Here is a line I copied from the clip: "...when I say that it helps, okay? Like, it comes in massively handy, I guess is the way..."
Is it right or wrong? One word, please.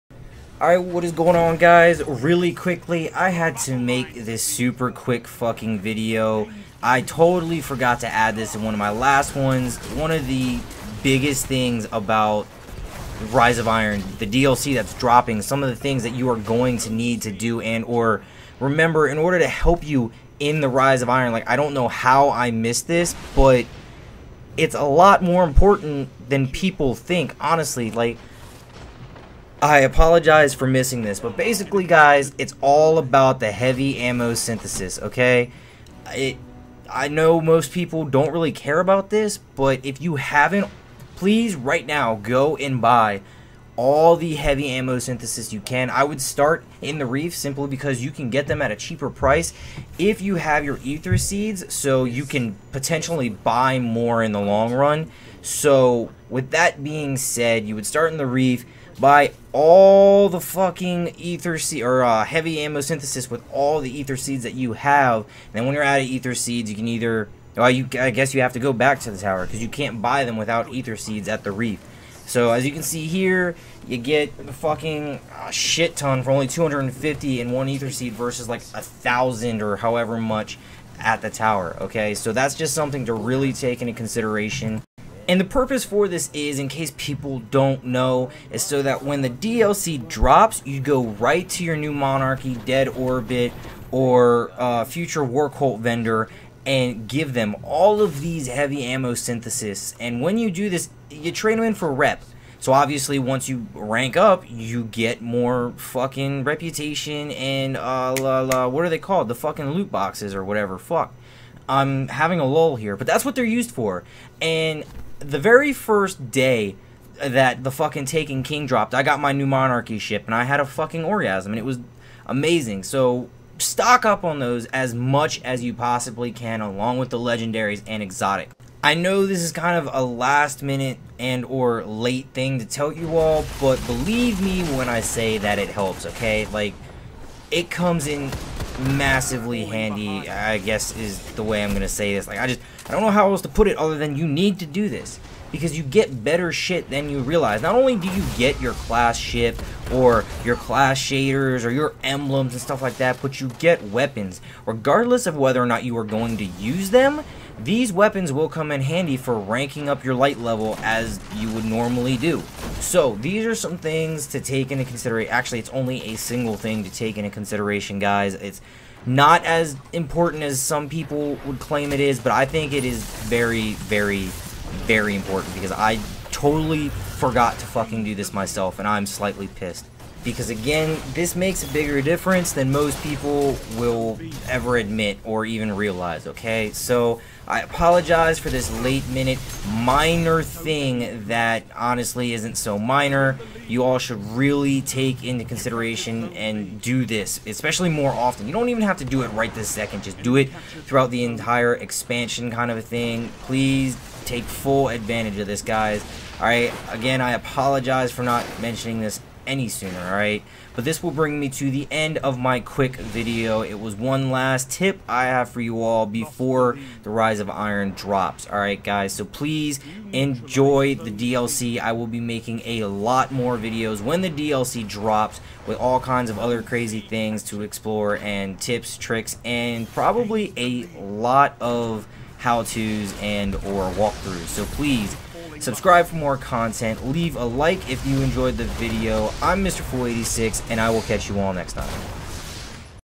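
right.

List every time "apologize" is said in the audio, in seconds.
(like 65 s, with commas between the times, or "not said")
29 s, 187 s, 207 s.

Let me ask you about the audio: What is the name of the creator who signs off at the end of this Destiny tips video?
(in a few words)
Mrfool86.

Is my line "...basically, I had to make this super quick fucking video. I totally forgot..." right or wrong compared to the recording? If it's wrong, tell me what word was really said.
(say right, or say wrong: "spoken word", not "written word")
wrong: "quickly", not "basically".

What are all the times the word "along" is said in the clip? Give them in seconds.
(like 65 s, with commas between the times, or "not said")
126 s.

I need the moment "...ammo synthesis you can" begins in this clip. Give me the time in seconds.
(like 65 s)
44 s.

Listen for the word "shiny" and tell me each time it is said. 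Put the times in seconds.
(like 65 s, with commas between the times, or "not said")
not said.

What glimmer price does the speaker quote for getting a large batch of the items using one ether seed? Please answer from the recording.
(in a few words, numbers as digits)
250.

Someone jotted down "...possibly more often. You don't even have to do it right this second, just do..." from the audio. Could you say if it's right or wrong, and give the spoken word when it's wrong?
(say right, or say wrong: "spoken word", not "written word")
wrong: "especially", not "possibly".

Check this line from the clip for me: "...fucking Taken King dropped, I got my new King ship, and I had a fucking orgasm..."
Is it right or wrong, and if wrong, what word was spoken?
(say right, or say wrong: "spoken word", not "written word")
wrong: "Monarchy", not "King".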